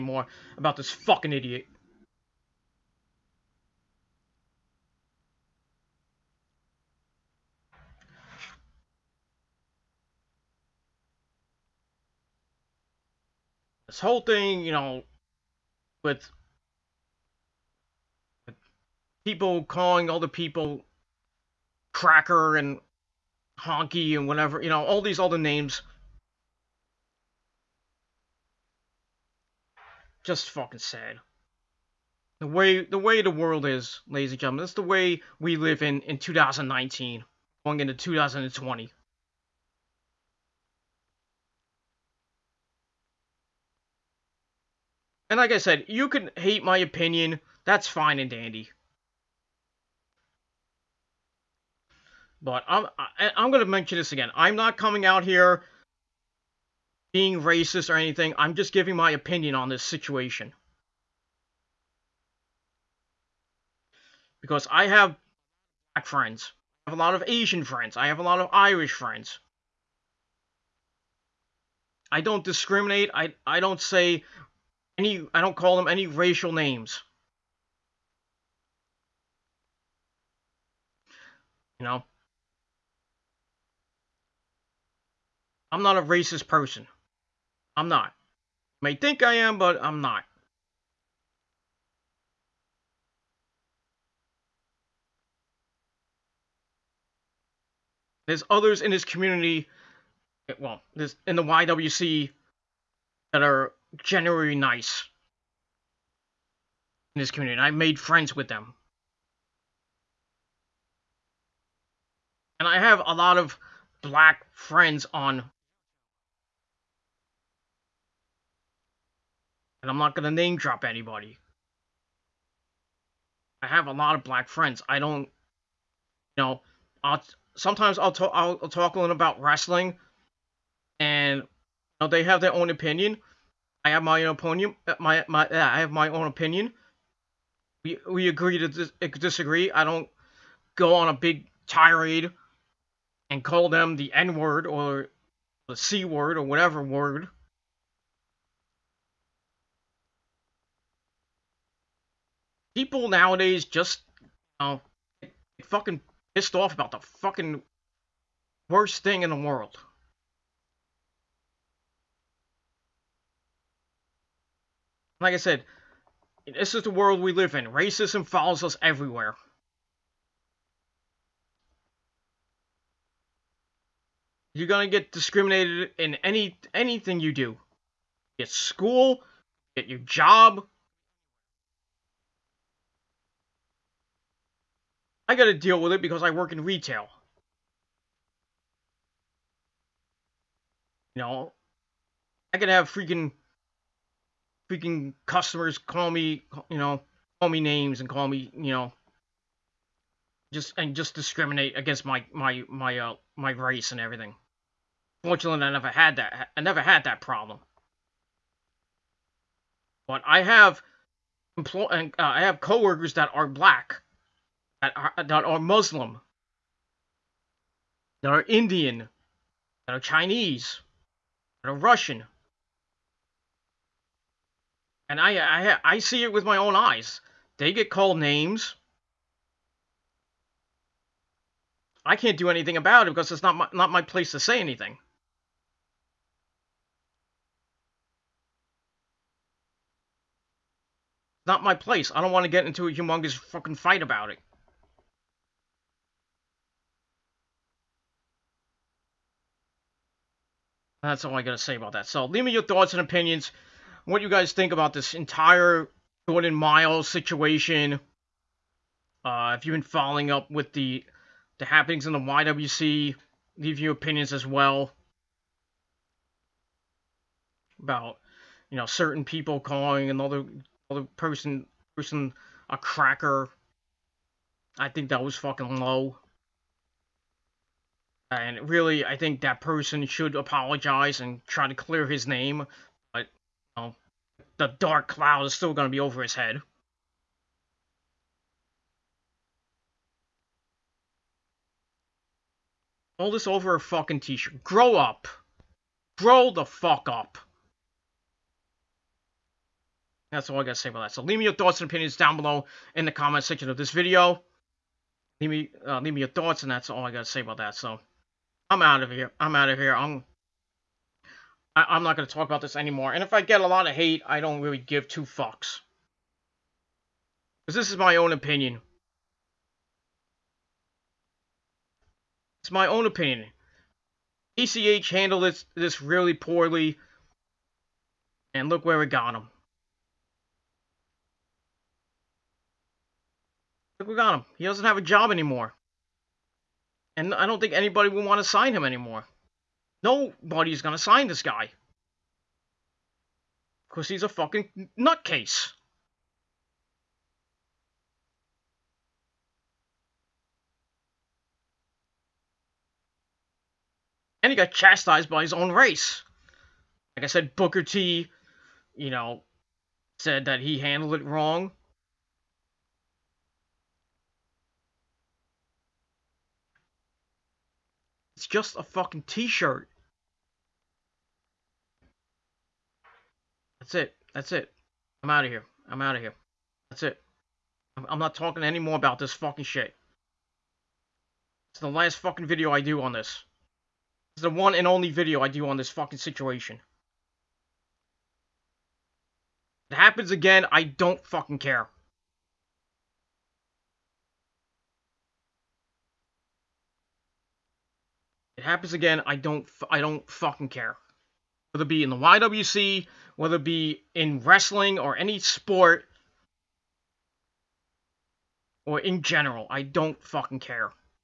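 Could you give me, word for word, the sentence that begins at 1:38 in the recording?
There's others in this community, well, there's in the YWC that are generally nice in this community.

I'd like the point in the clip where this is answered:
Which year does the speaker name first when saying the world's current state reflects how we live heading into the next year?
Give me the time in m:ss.
0:36.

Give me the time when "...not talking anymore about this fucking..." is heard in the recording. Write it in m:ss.
6:18.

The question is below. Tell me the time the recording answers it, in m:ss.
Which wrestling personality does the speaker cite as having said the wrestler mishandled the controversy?
5:57.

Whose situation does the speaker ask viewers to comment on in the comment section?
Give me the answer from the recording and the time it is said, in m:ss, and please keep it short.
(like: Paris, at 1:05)
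Jordan Myles, at 4:16.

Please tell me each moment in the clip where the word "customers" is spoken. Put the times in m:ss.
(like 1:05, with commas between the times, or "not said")
3:15.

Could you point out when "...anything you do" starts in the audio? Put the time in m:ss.
2:56.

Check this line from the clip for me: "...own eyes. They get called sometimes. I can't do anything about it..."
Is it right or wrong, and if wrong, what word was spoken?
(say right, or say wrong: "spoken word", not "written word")
wrong: "names", not "sometimes".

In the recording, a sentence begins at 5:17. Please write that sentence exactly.
Because this is my own opinion.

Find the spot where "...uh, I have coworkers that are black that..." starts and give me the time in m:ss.
3:31.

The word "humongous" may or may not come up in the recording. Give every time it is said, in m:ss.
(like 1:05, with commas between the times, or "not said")
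4:02.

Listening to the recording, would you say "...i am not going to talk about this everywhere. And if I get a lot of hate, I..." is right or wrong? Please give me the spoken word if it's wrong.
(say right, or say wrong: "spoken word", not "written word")
wrong: "anymore", not "everywhere".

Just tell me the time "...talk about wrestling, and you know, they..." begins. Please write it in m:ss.
2:08.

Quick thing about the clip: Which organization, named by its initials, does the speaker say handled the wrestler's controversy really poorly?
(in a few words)
ACH.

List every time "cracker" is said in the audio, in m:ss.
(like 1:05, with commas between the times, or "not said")
0:21, 4:32.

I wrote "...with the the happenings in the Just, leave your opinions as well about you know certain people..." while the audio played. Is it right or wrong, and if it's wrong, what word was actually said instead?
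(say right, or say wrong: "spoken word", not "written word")
wrong: "YWC", not "Just".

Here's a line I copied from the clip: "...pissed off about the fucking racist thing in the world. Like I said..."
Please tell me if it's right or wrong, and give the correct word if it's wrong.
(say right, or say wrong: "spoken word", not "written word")
wrong: "worst", not "racist".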